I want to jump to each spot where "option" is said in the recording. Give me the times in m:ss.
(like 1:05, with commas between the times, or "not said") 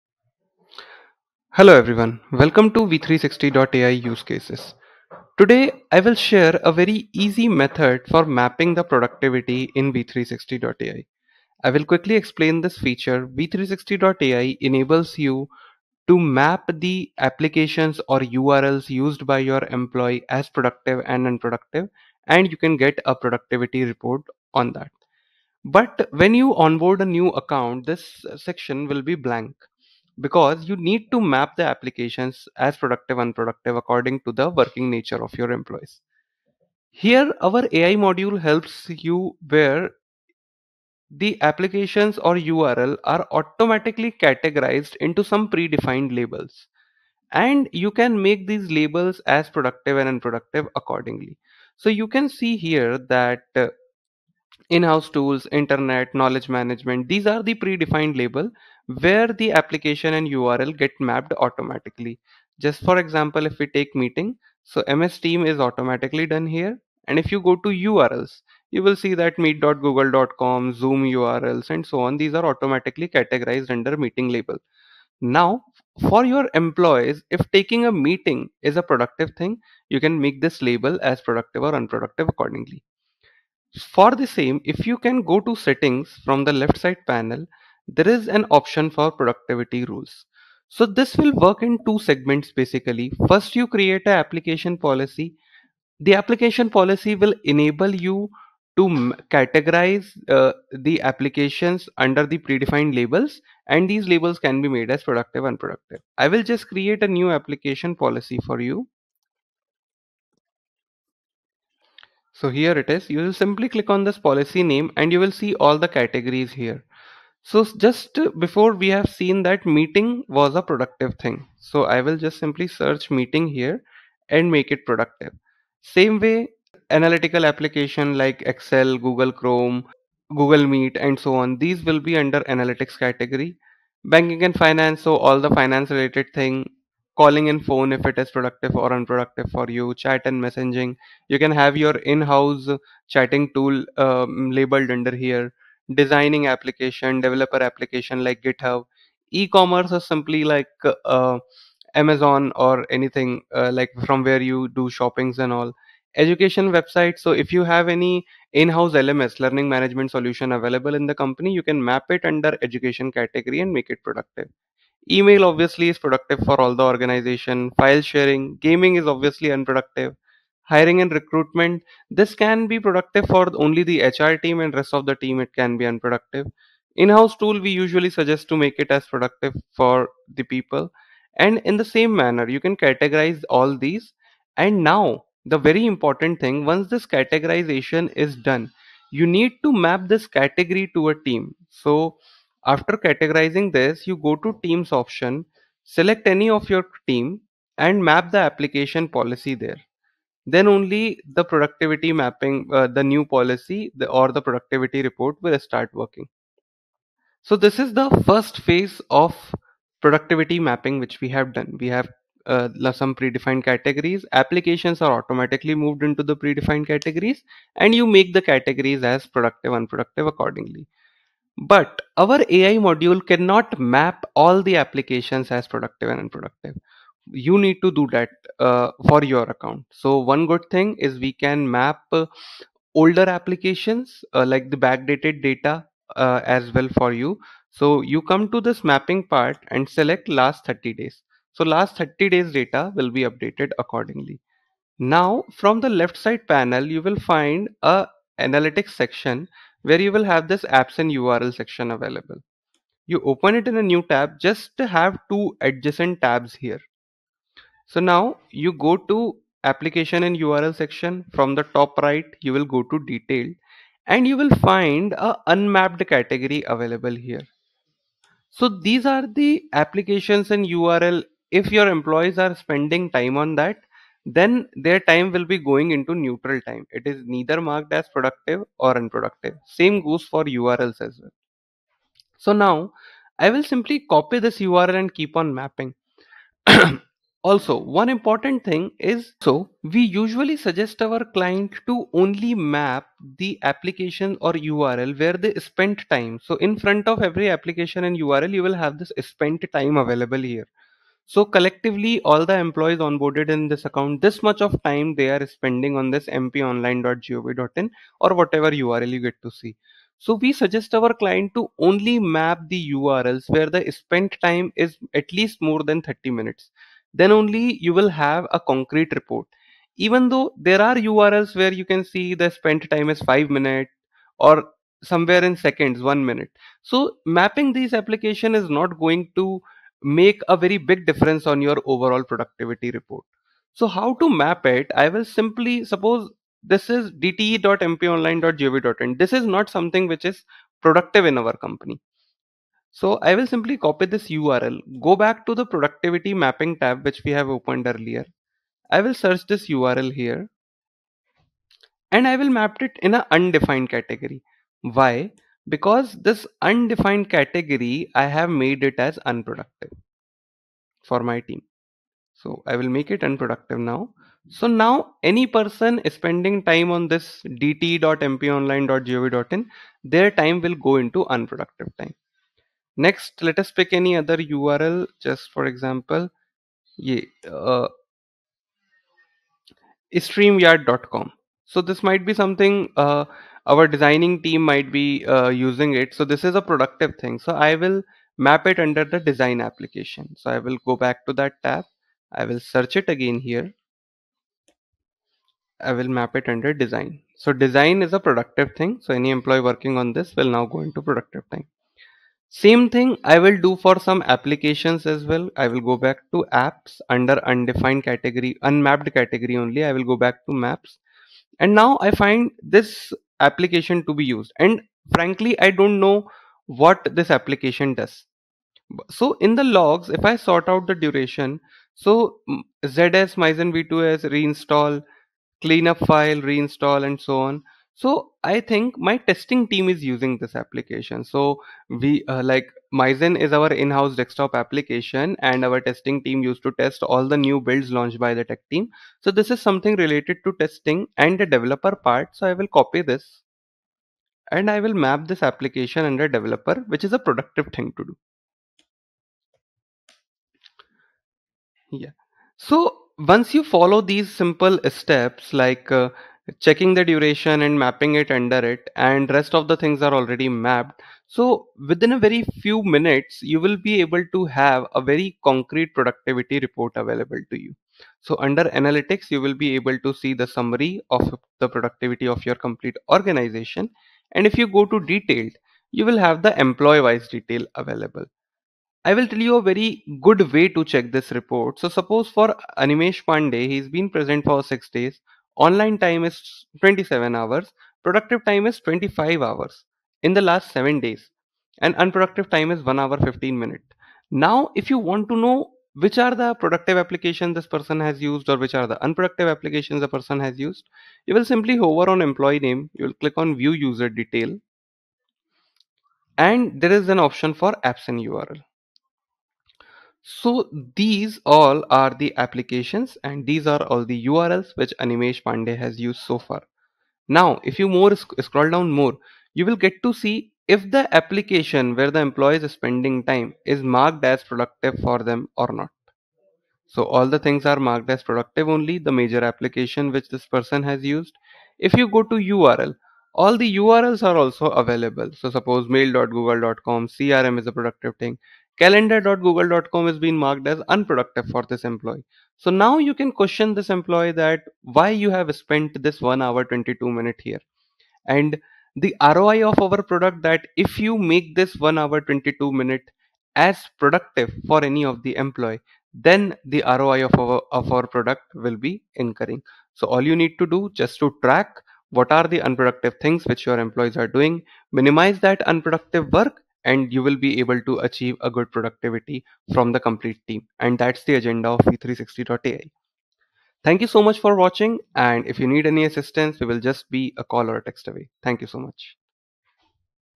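1:28, 3:15, 8:27.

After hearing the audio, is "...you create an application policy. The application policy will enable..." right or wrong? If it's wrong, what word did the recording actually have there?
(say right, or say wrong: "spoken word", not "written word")
right.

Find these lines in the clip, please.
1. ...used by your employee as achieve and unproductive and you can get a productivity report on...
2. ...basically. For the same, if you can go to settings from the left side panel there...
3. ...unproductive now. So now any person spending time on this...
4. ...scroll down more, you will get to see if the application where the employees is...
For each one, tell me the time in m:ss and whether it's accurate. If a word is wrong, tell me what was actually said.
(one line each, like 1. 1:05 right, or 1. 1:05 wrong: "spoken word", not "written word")
1. 0:18 wrong: "productive", not "achieve"
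2. 1:22 wrong: "accordingly", not "basically"
3. 6:03 right
4. 8:38 right.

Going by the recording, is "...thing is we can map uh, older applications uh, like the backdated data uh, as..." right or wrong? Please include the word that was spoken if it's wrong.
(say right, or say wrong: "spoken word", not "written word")
right.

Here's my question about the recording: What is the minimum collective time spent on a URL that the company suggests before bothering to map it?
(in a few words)
30 minutes.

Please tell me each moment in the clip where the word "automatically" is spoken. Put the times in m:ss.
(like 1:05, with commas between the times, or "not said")
0:43, 1:01, 1:05, 1:12, 3:35.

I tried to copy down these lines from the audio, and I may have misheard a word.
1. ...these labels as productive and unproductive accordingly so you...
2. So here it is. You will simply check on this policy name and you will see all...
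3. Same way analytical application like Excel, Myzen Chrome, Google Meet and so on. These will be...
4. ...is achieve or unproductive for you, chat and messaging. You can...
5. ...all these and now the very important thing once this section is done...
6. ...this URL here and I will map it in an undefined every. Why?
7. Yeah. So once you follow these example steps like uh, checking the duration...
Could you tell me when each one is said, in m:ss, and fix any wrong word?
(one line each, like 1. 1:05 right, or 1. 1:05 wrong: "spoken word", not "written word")
1. 0:48 right
2. 1:52 wrong: "click", not "check"
3. 2:05 wrong: "Google", not "Myzen"
4. 2:18 wrong: "productive", not "achieve"
5. 3:03 wrong: "categorization", not "section"
6. 5:49 wrong: "category", not "every"
7. 7:31 wrong: "simple", not "example".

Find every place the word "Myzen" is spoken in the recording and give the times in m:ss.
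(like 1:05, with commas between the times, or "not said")
7:03, 7:12.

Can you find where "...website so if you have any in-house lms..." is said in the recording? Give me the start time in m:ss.
2:36.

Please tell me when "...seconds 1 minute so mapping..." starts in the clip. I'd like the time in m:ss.
5:25.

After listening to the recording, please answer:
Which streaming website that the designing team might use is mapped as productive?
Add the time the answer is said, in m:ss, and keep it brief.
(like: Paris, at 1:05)
streamyard.com, at 6:20.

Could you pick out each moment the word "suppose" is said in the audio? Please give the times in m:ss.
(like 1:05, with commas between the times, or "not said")
5:35, 8:01, 8:55.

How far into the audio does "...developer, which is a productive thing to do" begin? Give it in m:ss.
7:26.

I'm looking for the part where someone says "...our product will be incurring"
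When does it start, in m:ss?
9:17.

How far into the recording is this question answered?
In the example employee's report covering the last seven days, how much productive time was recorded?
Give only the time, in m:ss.
8:08.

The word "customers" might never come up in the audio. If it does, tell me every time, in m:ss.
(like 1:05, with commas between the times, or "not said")
not said.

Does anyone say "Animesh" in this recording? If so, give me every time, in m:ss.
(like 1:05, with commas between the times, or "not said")
8:02, 8:34.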